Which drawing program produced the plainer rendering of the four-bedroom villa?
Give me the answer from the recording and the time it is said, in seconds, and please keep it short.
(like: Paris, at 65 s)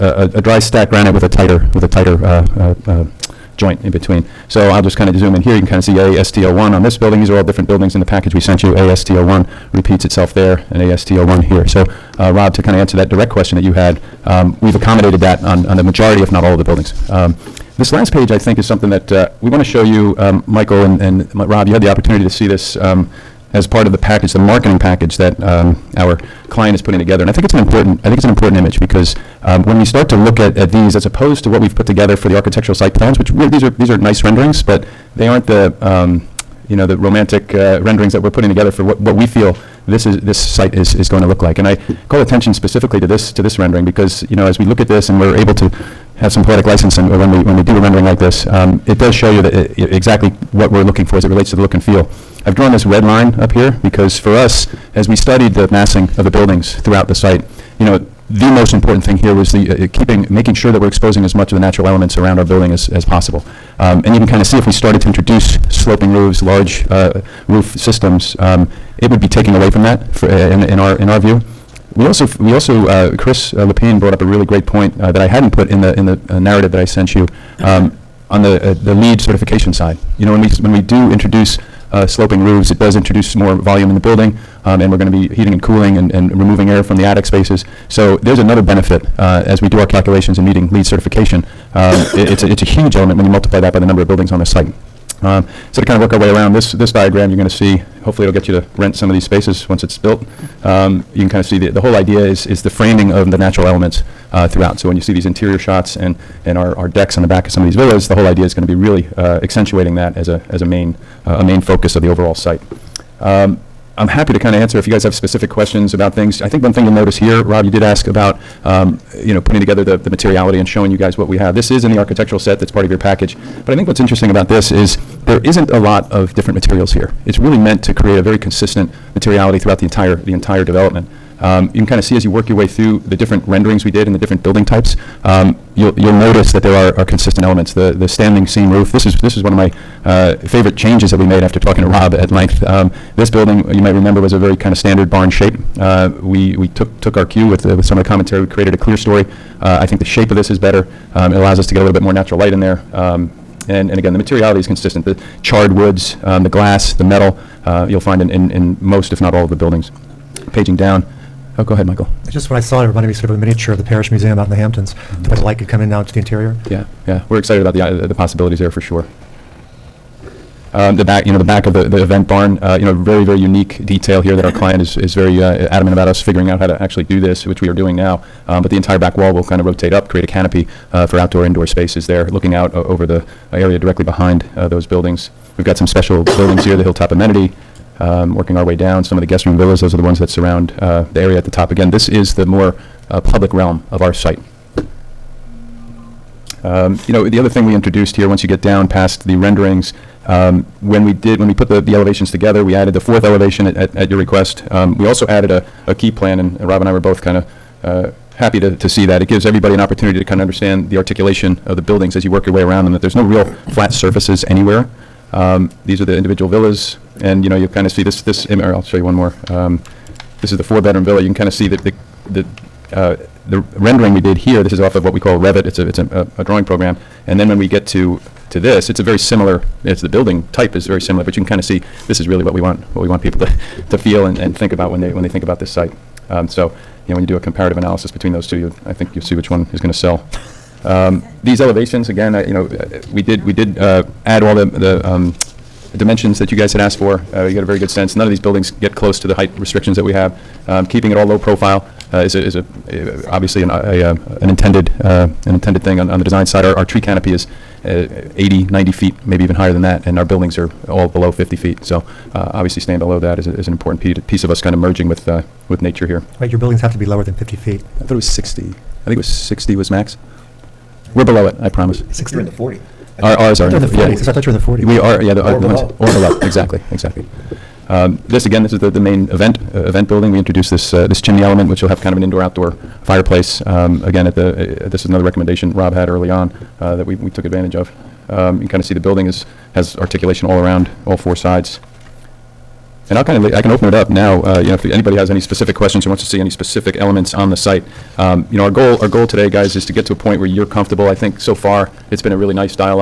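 Revit, at 225 s.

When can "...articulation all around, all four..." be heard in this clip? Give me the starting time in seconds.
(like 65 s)
289 s.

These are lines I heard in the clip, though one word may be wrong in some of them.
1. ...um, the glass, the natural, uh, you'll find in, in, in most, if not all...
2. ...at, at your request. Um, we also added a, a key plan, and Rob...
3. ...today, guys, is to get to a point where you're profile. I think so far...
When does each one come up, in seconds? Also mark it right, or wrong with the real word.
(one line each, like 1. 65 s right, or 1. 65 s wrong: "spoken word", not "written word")
1. 156 s wrong: "metal", not "natural"
2. 203 s right
3. 299 s wrong: "comfortable", not "profile".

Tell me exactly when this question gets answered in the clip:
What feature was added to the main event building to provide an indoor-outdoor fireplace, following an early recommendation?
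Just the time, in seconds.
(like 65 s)
281 s.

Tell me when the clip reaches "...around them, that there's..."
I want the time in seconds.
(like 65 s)
212 s.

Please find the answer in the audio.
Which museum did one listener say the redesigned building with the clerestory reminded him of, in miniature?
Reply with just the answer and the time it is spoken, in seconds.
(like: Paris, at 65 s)
Parrish Museum, at 163 s.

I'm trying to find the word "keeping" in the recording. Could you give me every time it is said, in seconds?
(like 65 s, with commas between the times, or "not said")
59 s, 250 s.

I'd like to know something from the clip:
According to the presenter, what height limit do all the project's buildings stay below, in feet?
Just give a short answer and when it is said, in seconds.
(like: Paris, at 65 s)
50 feet, at 261 s.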